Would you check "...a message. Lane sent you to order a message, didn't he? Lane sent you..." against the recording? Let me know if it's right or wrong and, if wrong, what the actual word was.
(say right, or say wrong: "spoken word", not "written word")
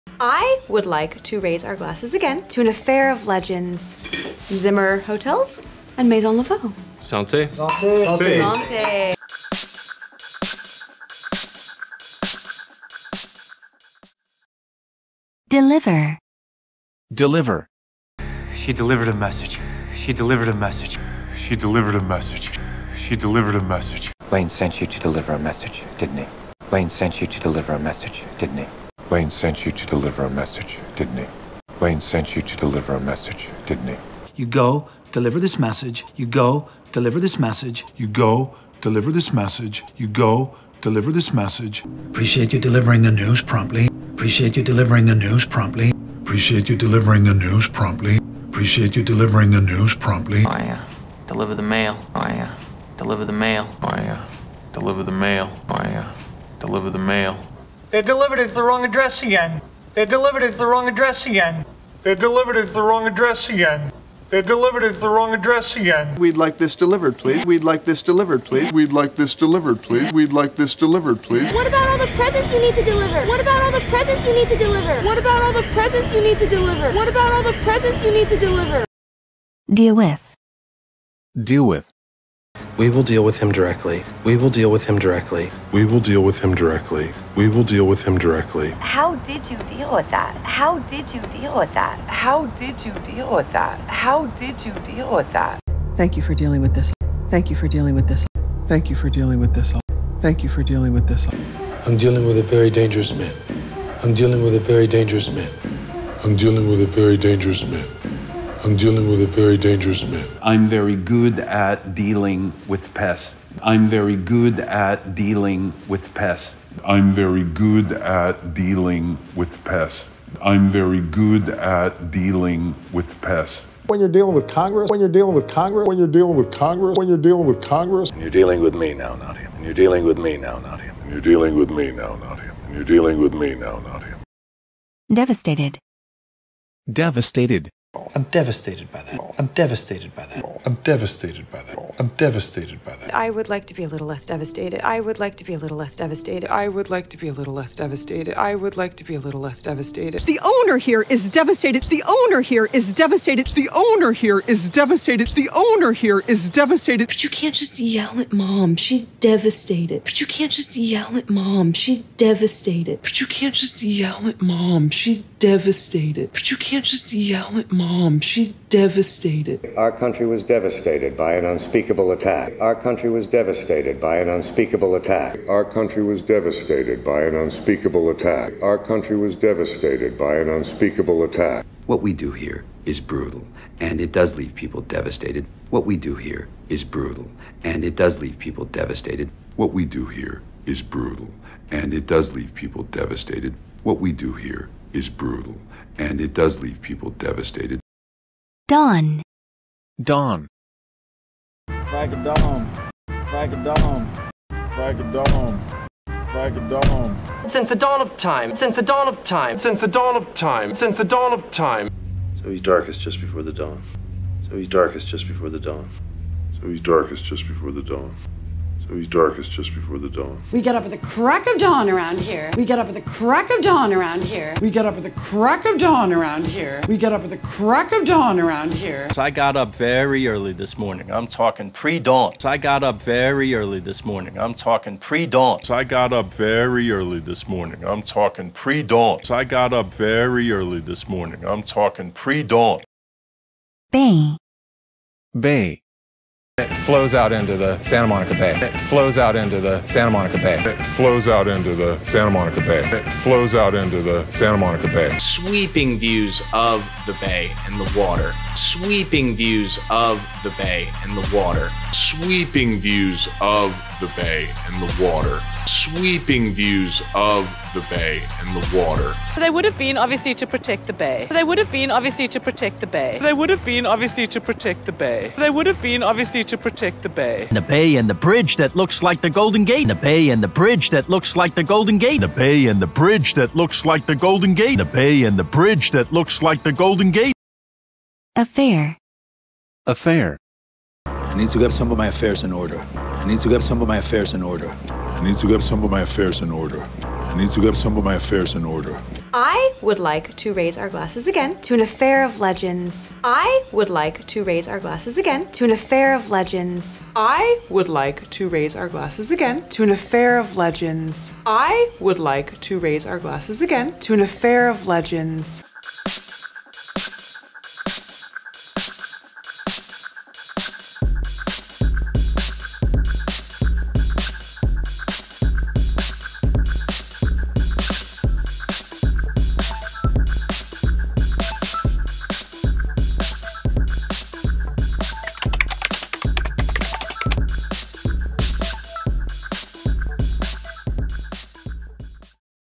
wrong: "deliver", not "order".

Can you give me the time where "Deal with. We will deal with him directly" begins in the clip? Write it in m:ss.
1:21.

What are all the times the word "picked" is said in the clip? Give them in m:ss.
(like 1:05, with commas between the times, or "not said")
not said.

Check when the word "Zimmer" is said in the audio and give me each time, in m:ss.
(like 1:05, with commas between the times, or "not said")
0:04.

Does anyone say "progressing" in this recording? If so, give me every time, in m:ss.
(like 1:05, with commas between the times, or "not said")
not said.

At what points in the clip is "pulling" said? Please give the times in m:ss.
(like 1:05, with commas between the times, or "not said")
not said.